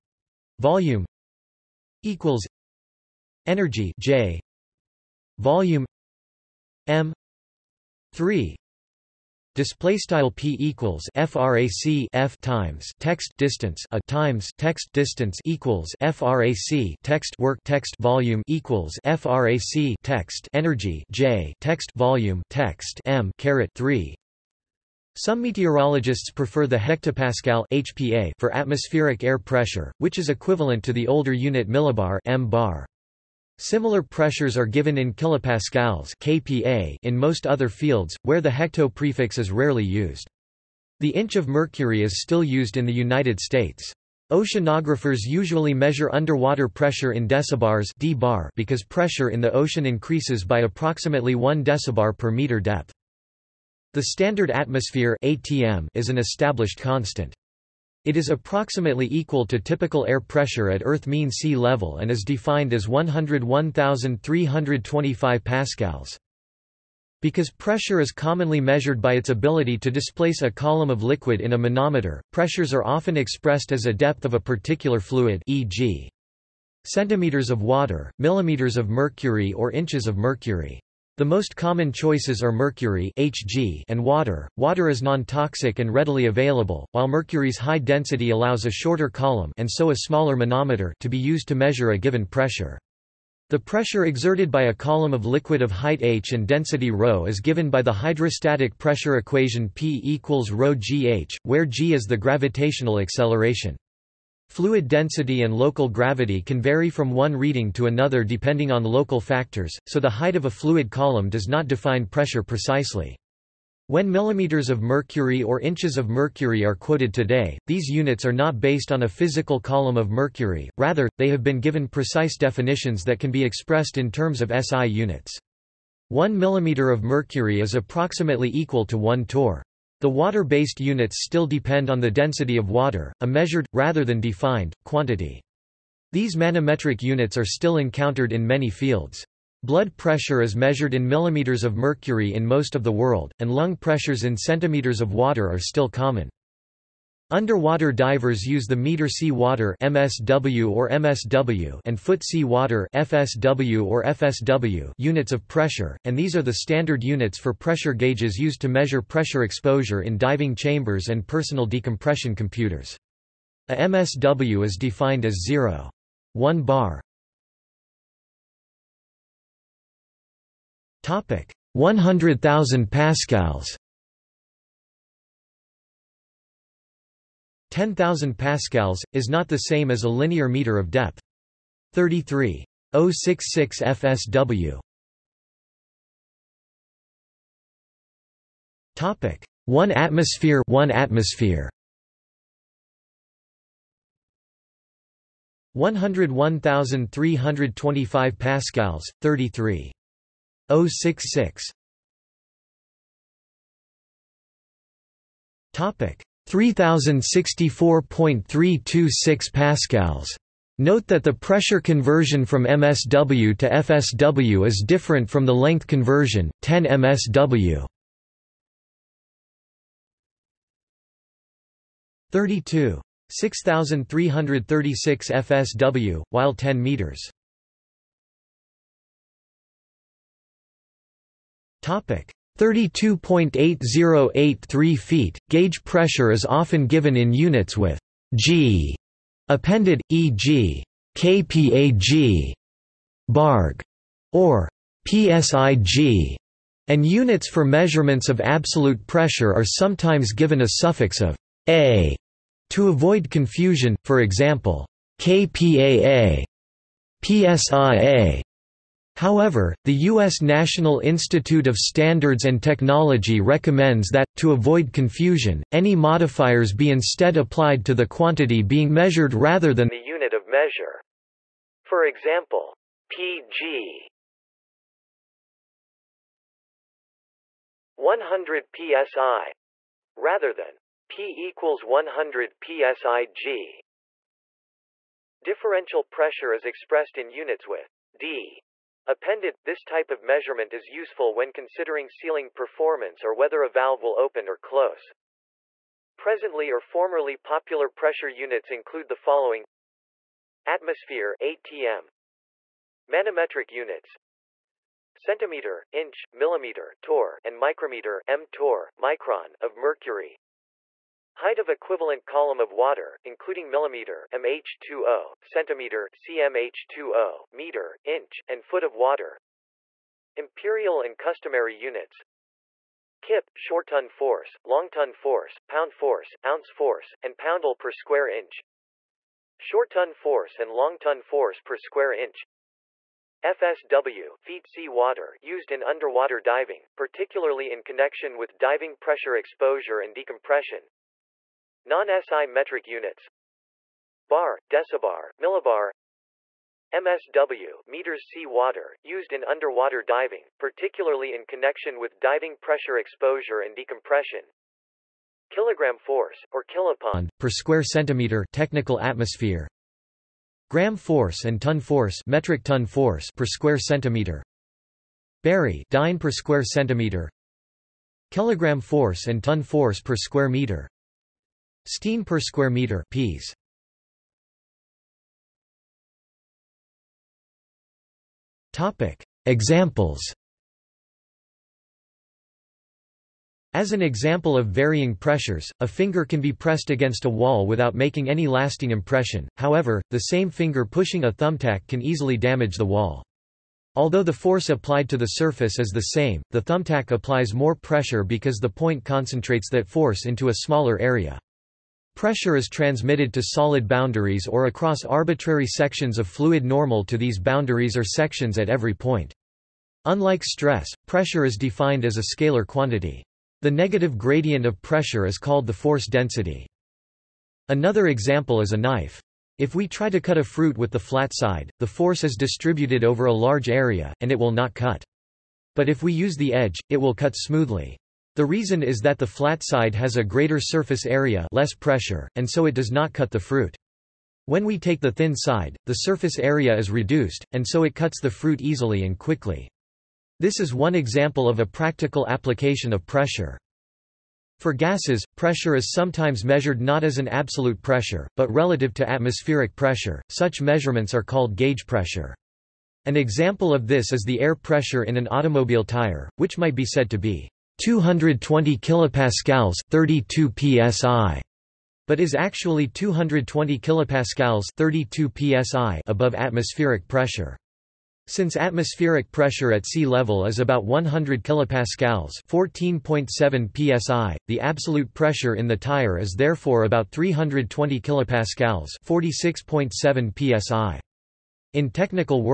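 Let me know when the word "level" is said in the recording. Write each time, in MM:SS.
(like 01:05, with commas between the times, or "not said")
01:01, 07:50.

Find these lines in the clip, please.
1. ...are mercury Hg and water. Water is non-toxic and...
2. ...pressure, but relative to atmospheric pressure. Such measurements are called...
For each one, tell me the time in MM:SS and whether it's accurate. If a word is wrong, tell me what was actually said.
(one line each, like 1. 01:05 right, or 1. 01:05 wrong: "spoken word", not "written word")
1. 01:22 right
2. 07:27 right.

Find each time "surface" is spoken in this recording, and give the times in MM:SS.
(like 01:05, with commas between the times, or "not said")
06:35, 07:10, 07:15.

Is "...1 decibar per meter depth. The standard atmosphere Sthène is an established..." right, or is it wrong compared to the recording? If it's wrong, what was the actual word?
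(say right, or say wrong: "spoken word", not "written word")
wrong: "ATM", not "Sthène".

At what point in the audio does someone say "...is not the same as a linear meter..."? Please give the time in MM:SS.
02:59.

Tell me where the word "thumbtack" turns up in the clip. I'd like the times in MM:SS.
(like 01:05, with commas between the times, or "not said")
06:31, 06:36.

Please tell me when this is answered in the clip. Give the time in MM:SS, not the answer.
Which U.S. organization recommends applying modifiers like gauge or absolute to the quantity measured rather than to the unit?
04:20.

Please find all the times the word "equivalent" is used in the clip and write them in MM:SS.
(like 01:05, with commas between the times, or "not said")
00:30, 05:11.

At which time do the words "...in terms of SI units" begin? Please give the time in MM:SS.
02:03.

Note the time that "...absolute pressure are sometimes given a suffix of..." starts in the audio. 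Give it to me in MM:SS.
04:08.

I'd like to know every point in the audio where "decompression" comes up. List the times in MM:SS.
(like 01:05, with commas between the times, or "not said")
02:41, 05:40, 05:53.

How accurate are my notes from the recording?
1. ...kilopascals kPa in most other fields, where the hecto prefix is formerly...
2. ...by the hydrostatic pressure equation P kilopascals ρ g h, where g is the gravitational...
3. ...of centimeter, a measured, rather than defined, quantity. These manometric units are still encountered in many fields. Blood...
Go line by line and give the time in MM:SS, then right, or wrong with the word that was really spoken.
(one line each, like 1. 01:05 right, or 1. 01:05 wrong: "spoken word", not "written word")
1. 00:35 wrong: "rarely", not "formerly"
2. 01:37 wrong: "equals", not "kilopascals"
3. 02:12 wrong: "water", not "centimeter".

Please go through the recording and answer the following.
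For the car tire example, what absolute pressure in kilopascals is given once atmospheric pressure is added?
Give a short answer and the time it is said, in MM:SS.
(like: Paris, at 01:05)
320 kilopascals, at 07:57.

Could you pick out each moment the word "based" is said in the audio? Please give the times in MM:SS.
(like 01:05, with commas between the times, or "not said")
01:58, 02:10.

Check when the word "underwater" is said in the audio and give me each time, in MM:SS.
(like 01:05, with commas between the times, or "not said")
00:46, 02:27, 05:35, 05:49.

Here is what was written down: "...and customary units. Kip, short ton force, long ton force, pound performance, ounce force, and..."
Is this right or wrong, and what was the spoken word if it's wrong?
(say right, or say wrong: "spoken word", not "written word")
wrong: "force", not "performance".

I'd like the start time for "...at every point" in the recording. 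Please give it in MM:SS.
06:48.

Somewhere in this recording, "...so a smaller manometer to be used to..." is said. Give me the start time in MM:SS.
01:29.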